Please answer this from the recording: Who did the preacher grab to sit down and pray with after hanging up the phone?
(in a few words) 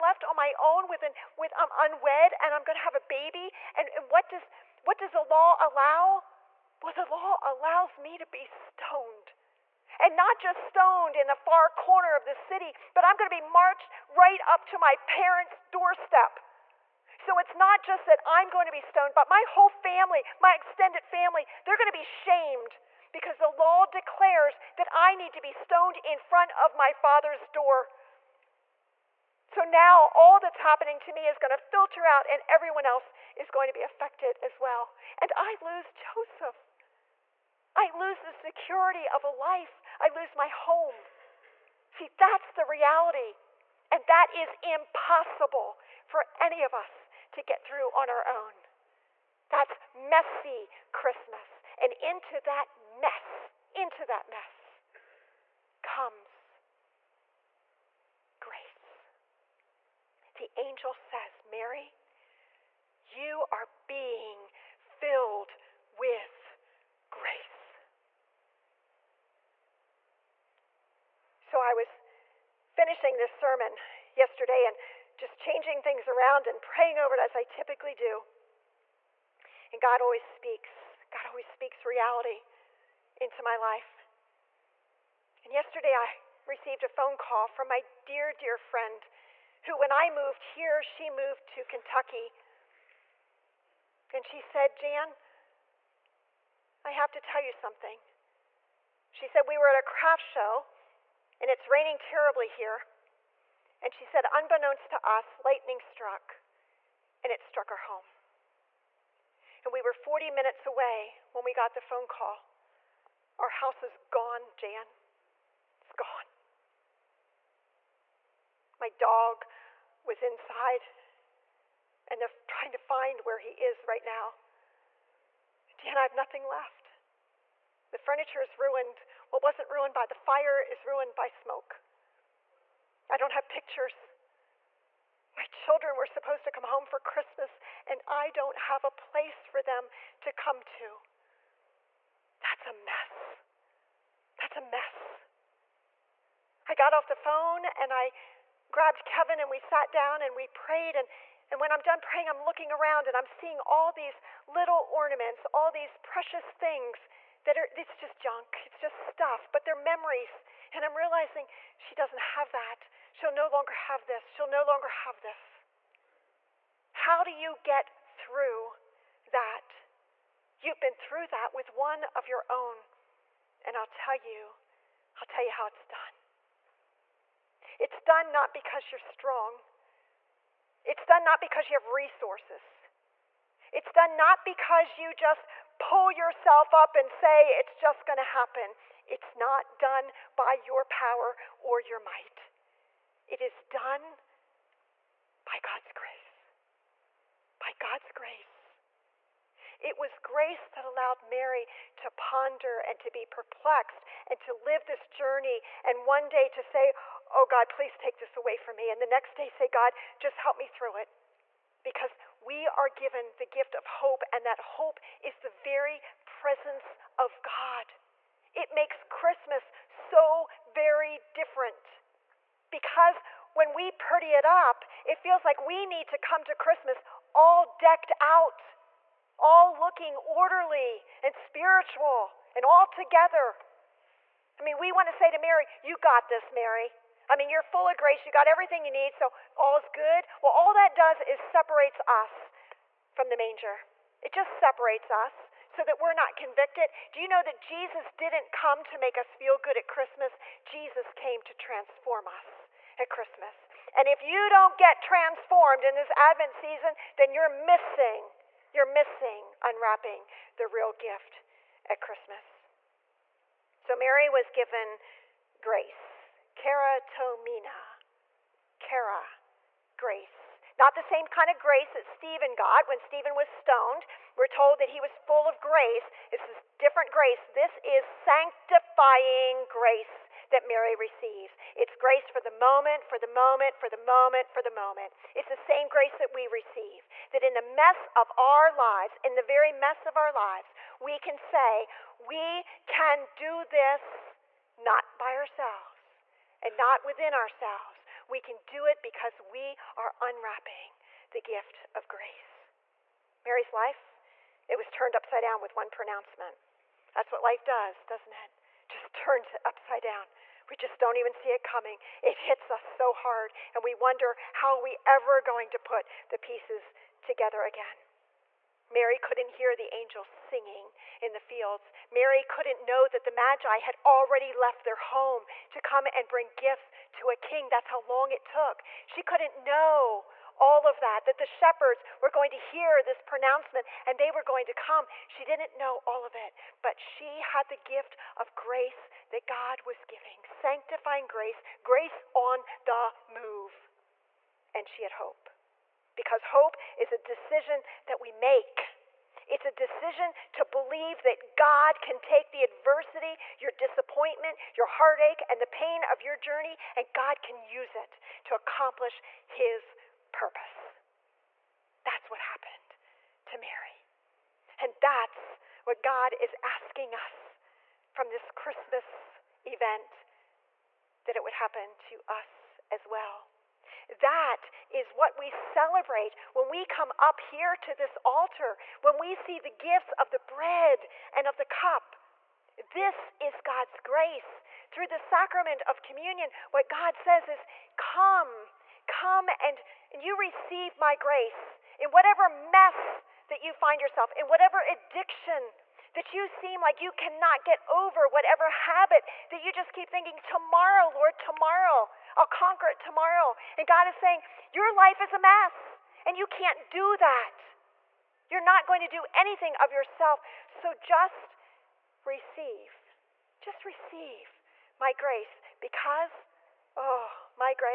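Kevin.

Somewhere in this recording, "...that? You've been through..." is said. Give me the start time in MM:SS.
02:49.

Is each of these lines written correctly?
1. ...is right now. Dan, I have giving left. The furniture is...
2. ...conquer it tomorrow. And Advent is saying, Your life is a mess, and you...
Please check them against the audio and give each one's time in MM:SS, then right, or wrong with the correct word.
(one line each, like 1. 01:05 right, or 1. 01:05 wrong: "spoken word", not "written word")
1. 02:03 wrong: "nothing", not "giving"
2. 06:42 wrong: "God", not "Advent".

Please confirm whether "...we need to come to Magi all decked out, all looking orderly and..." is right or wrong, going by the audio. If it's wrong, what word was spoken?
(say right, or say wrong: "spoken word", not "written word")
wrong: "Christmas", not "Magi".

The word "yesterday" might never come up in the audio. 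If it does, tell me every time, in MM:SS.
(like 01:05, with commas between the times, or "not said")
01:14, 01:25.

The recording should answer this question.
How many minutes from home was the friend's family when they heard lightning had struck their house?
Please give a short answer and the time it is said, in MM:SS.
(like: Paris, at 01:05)
40, at 01:49.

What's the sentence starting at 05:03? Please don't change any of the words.
Mary's life, it was turned upside down with one pronouncement.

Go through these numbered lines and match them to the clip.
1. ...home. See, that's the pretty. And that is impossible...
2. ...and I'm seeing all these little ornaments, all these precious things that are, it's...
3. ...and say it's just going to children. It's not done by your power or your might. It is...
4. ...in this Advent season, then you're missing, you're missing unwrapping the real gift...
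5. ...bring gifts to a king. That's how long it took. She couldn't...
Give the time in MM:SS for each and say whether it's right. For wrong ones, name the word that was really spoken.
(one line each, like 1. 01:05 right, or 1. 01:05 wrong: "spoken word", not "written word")
1. 00:40 wrong: "reality", not "pretty"
2. 02:33 right
3. 03:06 wrong: "happen", not "children"
4. 04:15 right
5. 05:26 right.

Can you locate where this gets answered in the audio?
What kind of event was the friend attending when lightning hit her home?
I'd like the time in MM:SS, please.
01:39.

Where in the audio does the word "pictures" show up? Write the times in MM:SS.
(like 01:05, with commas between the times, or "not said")
02:13.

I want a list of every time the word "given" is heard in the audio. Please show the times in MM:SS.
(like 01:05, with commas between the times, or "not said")
03:32, 04:24.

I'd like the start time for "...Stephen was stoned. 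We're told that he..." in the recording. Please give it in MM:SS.
04:32.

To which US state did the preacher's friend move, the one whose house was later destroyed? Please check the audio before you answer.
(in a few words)
Kentucky.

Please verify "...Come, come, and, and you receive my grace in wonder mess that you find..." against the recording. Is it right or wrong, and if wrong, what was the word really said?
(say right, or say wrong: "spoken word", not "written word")
wrong: "whatever", not "wonder".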